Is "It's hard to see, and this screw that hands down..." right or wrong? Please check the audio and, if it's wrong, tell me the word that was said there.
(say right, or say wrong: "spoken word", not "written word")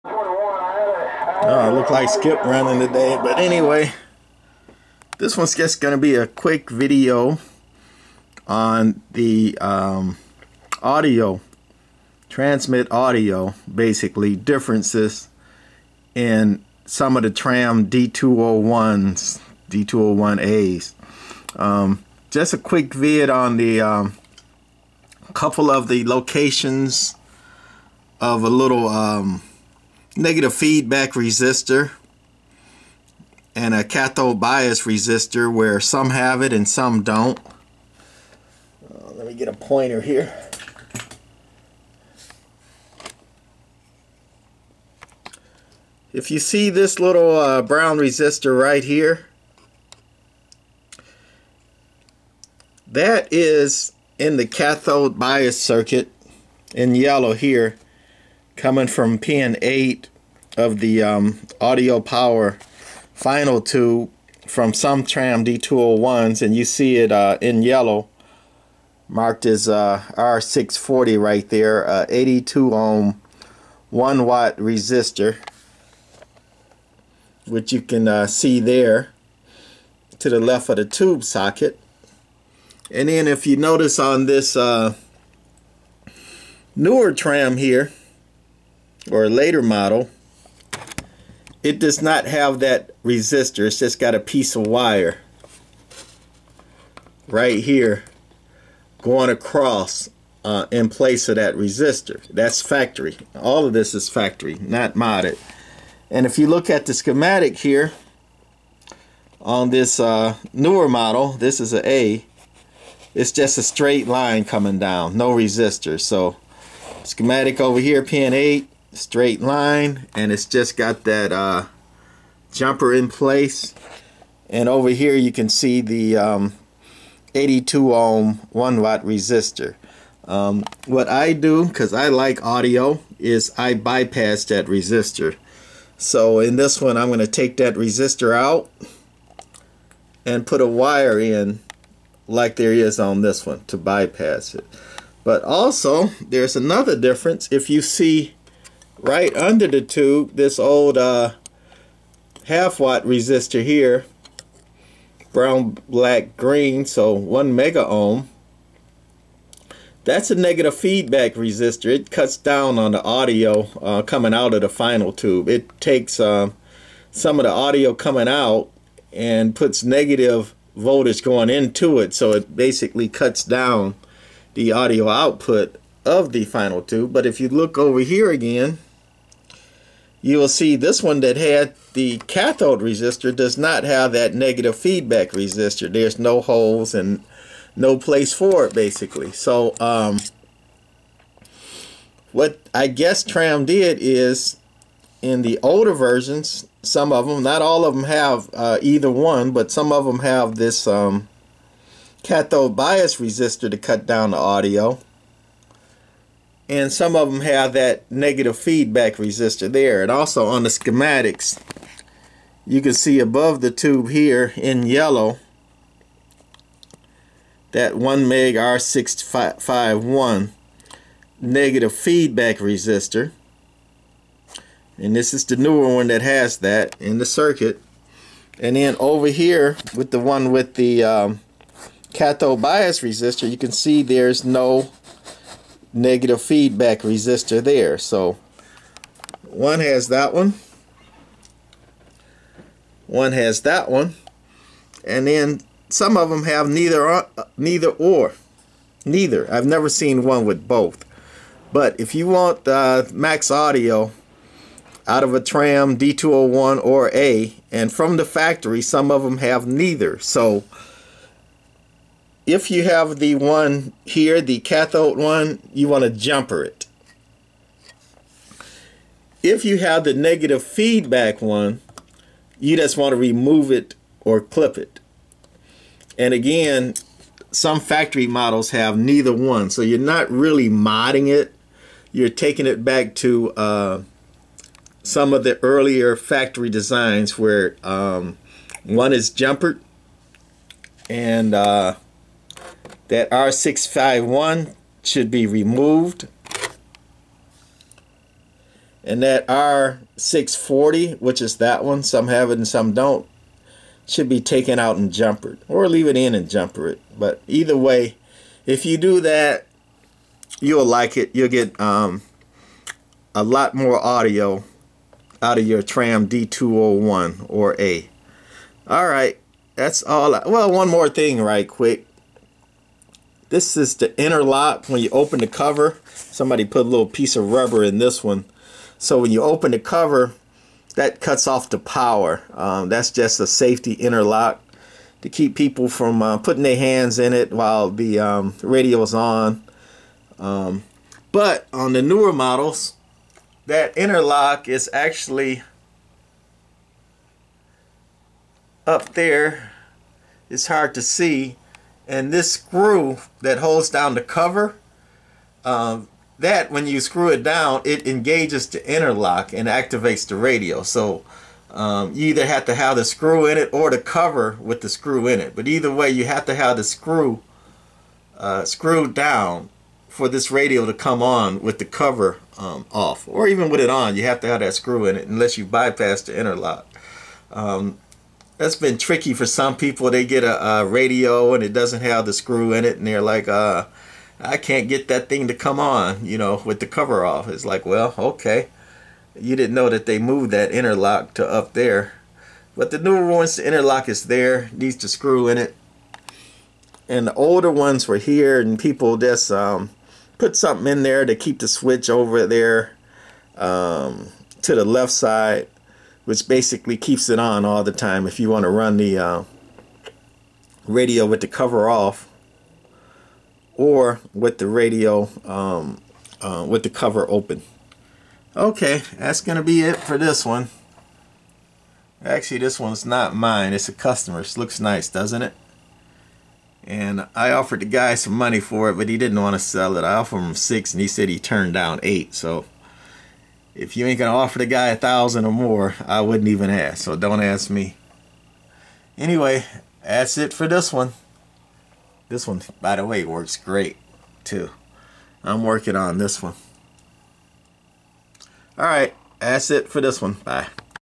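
wrong: "holds", not "hands".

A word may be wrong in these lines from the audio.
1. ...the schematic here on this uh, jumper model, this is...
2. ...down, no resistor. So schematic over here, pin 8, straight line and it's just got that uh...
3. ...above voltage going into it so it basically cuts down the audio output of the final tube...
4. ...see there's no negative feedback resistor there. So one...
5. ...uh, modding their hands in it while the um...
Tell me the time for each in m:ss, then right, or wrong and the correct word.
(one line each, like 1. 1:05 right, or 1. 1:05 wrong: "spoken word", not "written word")
1. 1:46 wrong: "newer", not "jumper"
2. 1:54 right
3. 2:49 wrong: "negative", not "above"
4. 3:53 right
5. 5:36 wrong: "putting", not "modding".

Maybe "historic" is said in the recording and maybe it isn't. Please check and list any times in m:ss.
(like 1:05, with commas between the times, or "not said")
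not said.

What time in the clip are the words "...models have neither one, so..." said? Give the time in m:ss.
4:38.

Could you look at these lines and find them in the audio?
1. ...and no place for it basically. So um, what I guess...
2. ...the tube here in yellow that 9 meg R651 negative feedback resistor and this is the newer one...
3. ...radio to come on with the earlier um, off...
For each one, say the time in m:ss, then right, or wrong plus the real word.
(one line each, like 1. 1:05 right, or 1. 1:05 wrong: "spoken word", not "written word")
1. 3:06 right
2. 3:33 wrong: "1", not "9"
3. 6:10 wrong: "cover", not "earlier".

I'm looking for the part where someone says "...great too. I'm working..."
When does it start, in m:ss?
7:23.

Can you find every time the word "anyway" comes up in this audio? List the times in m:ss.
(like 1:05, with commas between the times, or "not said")
0:03, 7:19.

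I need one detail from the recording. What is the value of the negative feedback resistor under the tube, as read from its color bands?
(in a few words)
1 megohm.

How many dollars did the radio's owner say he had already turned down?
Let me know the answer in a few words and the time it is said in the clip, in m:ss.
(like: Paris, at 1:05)
8, at 7:12.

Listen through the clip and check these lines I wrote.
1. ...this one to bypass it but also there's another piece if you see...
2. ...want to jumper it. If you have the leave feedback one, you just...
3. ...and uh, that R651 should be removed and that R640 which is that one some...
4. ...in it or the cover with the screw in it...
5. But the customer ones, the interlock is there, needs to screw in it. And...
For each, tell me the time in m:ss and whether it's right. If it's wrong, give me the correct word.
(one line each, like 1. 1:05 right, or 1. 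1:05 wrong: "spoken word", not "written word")
1. 2:23 wrong: "difference", not "piece"
2. 4:25 wrong: "negative", not "leave"
3. 4:51 right
4. 6:03 right
5. 6:32 wrong: "newer", not "customer".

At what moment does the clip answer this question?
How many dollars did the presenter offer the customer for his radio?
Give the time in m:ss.
7:10.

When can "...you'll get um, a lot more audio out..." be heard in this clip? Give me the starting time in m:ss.
5:11.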